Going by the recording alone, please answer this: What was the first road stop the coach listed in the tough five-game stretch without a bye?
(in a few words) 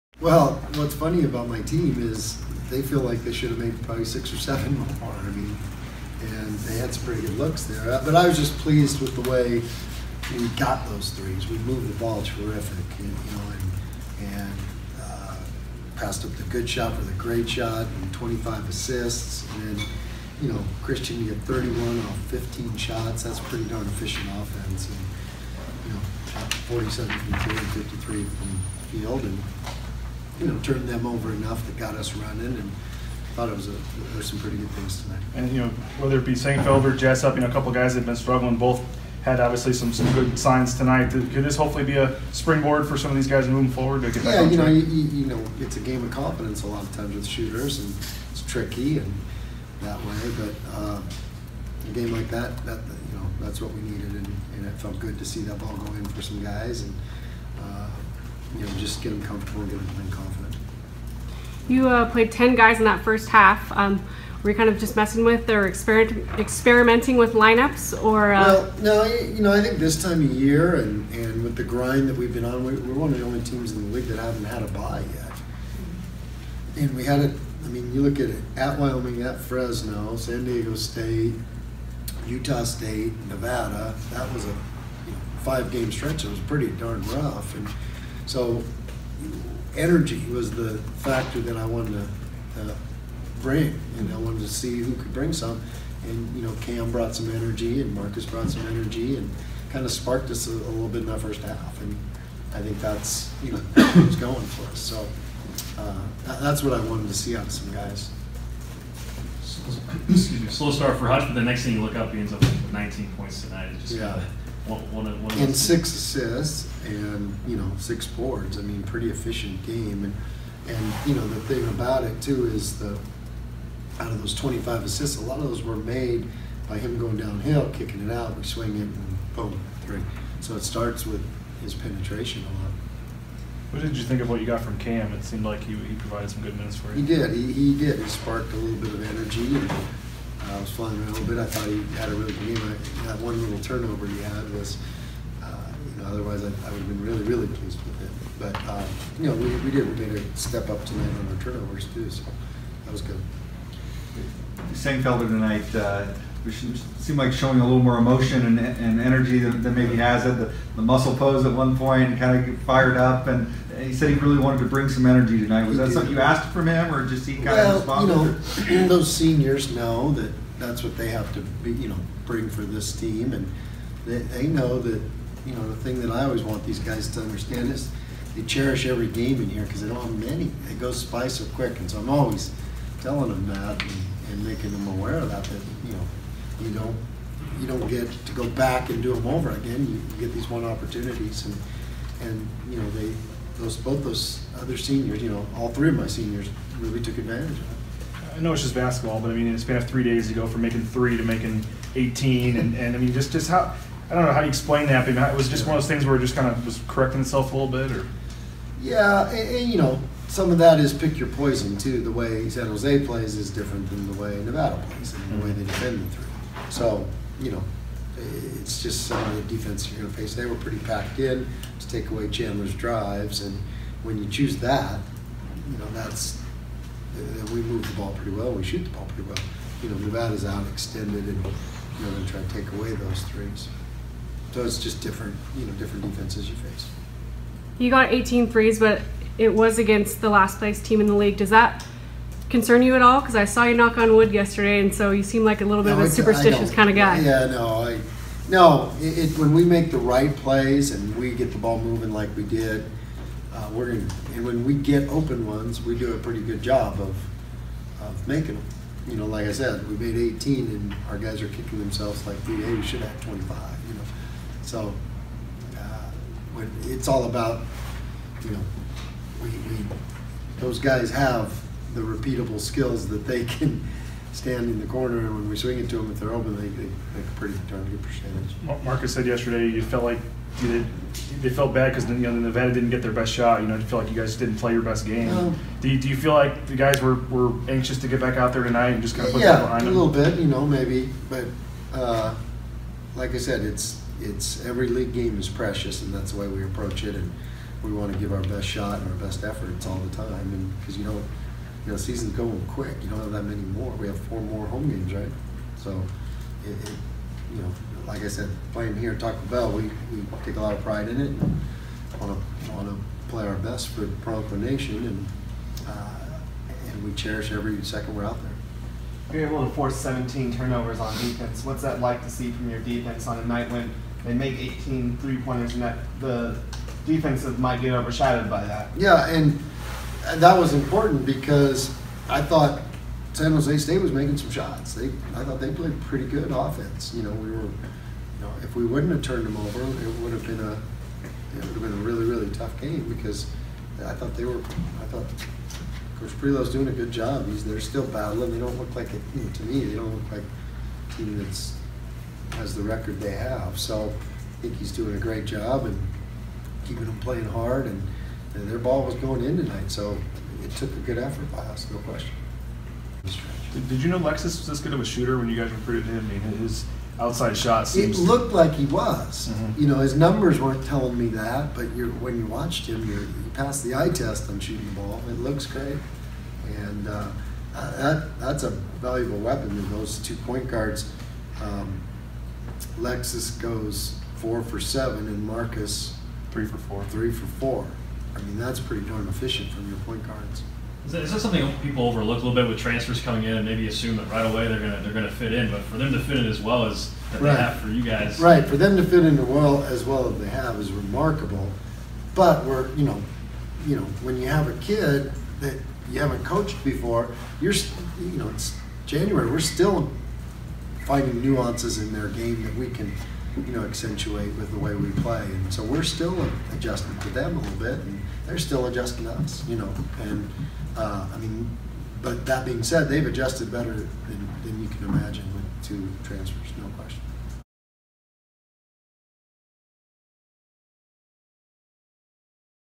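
Wyoming.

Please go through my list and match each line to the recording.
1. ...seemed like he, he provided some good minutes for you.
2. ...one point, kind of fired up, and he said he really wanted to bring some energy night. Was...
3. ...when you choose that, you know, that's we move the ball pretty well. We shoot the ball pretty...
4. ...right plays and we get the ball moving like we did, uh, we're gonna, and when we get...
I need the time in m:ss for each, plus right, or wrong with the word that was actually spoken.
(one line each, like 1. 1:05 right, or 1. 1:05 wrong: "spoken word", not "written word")
1. 2:15 right
2. 2:41 wrong: "tonight", not "night"
3. 3:44 right
4. 4:09 right.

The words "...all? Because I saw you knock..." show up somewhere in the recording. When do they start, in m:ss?
4:03.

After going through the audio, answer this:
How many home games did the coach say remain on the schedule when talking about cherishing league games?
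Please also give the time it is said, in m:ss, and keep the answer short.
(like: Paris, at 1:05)
4, at 5:04.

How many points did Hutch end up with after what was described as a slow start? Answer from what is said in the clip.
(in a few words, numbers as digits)
19.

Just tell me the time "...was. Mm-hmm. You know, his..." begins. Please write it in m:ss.
6:08.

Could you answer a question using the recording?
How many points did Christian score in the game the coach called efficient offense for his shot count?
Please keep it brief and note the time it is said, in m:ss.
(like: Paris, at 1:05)
31, at 0:21.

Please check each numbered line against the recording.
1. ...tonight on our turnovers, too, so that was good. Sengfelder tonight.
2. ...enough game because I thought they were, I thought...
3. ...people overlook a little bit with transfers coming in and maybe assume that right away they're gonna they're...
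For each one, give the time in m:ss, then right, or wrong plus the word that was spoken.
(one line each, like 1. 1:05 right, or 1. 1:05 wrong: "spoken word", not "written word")
1. 2:30 right
2. 5:42 wrong: "tough", not "enough"
3. 6:31 right.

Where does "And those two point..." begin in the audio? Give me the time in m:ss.
6:19.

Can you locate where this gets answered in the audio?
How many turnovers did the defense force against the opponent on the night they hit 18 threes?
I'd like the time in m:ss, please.
5:19.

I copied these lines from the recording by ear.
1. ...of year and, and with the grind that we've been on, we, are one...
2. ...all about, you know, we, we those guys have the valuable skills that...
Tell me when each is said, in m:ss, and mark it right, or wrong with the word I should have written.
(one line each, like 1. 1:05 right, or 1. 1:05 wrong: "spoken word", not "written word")
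1. 1:10 right
2. 4:27 wrong: "repeatable", not "valuable".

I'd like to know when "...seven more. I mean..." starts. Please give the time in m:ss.
0:04.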